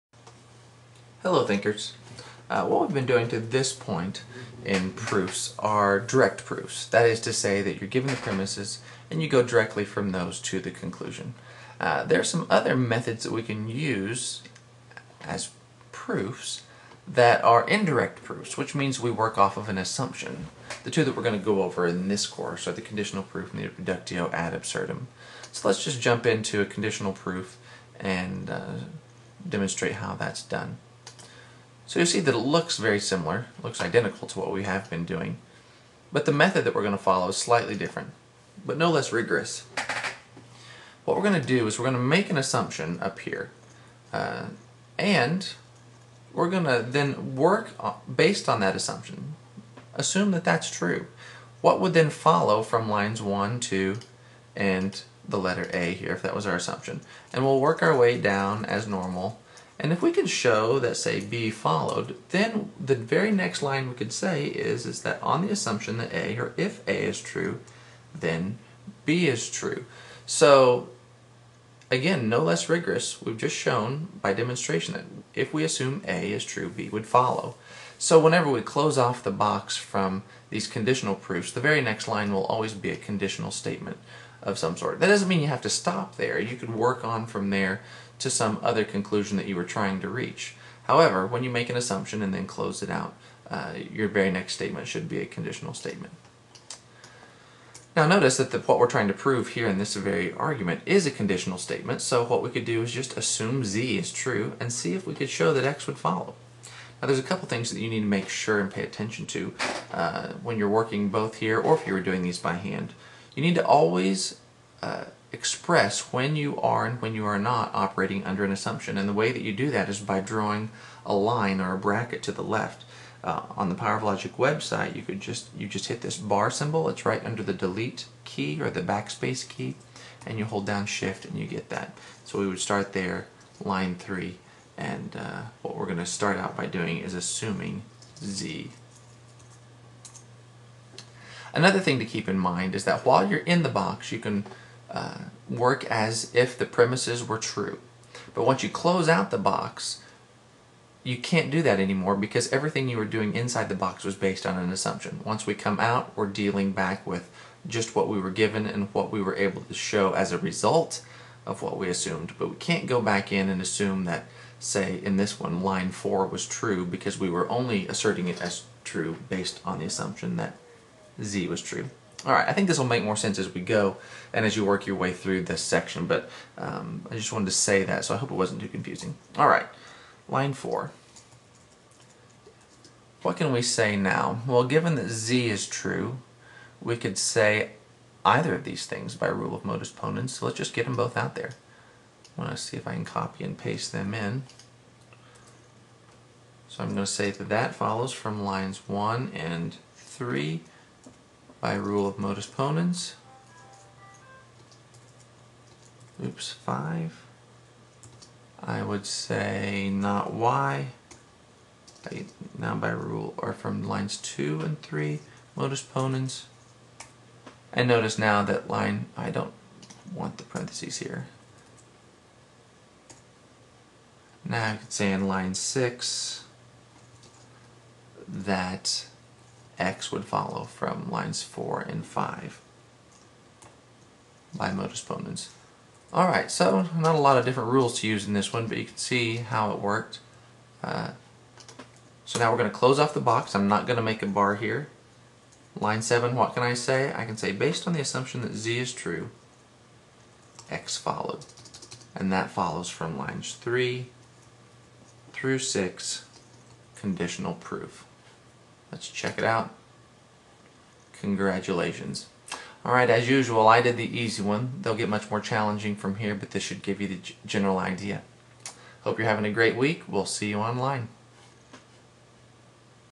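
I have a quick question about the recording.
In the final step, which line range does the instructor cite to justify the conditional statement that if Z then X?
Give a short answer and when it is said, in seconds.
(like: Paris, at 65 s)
lines 3 through 6, at 253 s.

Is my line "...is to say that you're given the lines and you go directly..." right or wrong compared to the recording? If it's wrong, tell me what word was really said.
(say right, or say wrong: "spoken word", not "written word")
wrong: "premises", not "lines".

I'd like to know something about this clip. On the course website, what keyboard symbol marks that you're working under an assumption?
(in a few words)
bar symbol.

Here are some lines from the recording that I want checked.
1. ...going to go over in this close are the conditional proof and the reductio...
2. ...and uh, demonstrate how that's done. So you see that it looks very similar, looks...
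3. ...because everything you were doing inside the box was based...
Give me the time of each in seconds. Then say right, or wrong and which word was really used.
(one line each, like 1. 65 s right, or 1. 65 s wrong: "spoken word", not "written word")
1. 21 s wrong: "course", not "close"
2. 27 s right
3. 152 s right.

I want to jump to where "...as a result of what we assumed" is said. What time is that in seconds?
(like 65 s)
160 s.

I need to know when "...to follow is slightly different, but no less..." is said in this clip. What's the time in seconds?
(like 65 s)
36 s.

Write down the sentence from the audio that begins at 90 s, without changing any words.
However, when you make an assumption and then close it out, uh, your very next statement should be a conditional statement.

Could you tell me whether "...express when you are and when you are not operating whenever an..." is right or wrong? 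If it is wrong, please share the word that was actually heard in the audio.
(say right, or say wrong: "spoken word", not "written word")
wrong: "under", not "whenever".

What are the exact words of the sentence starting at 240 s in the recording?
Uh, so now we're going to close off the box.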